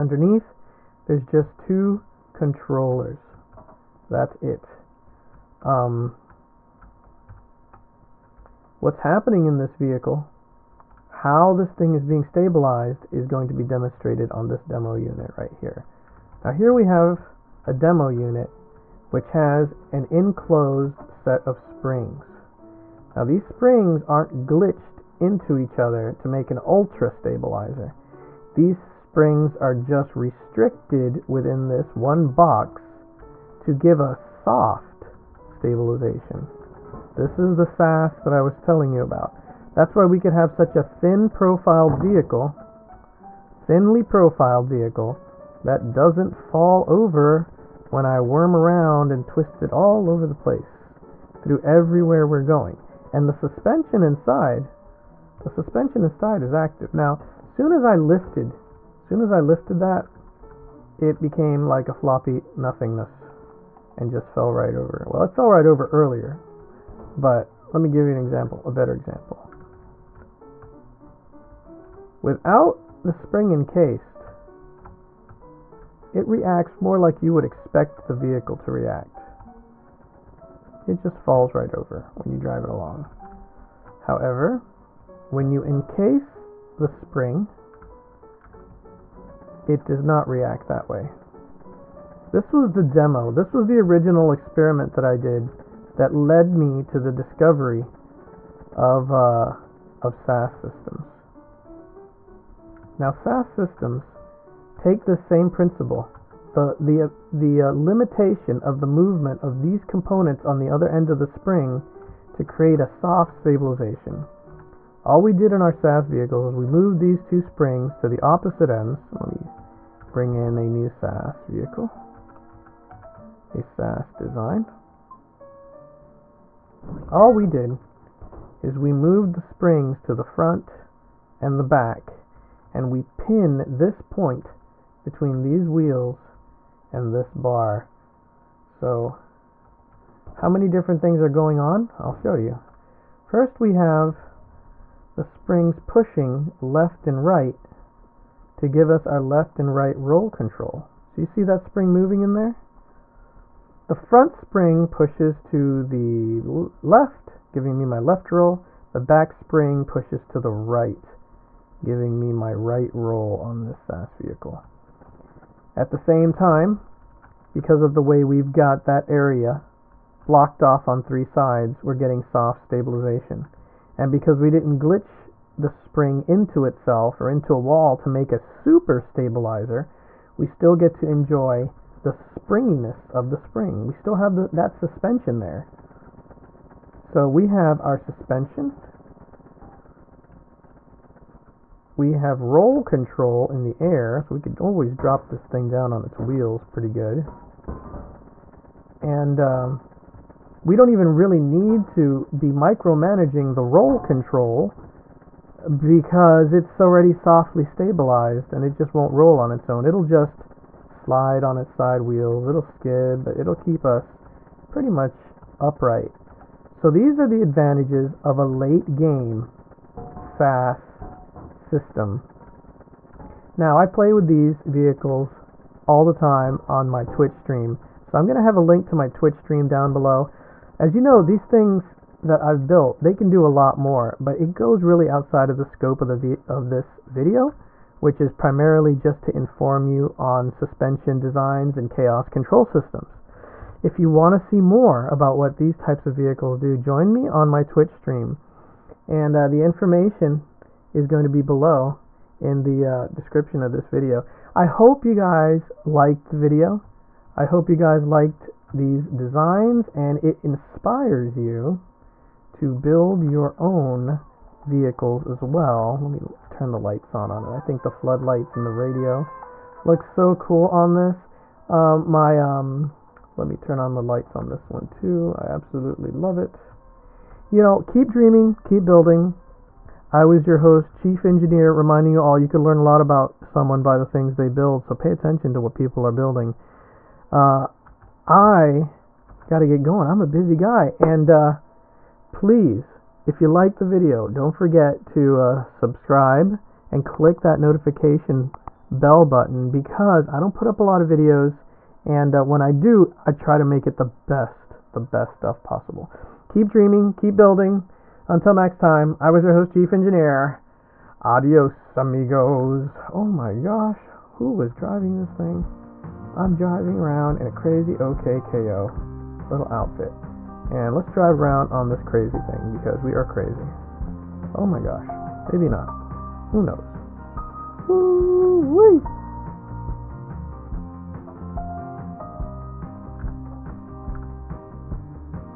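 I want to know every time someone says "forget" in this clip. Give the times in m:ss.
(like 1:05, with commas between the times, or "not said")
4:54.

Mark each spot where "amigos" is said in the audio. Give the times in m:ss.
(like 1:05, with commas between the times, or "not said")
5:11.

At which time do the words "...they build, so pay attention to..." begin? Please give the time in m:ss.
4:44.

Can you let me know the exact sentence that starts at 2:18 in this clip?
So how many different things are going on?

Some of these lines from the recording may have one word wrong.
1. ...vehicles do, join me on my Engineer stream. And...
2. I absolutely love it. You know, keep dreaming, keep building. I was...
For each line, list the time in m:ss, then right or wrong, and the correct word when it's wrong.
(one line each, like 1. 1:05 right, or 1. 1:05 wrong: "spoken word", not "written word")
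1. 4:06 wrong: "Twitch", not "Engineer"
2. 4:35 right.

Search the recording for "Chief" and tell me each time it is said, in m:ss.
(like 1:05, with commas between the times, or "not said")
4:40, 5:09.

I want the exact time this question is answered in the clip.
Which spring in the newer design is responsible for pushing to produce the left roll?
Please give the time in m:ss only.
2:34.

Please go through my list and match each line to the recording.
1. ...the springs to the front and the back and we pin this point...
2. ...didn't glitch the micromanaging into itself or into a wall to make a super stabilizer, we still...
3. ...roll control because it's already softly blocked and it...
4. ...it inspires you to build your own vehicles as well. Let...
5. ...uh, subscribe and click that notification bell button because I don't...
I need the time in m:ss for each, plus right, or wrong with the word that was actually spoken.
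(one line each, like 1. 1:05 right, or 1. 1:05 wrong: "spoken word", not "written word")
1. 2:09 right
2. 2:54 wrong: "spring", not "micromanaging"
3. 3:23 wrong: "stabilized", not "blocked"
4. 4:20 right
5. 4:55 right.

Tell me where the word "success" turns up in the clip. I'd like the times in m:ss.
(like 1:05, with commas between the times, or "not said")
not said.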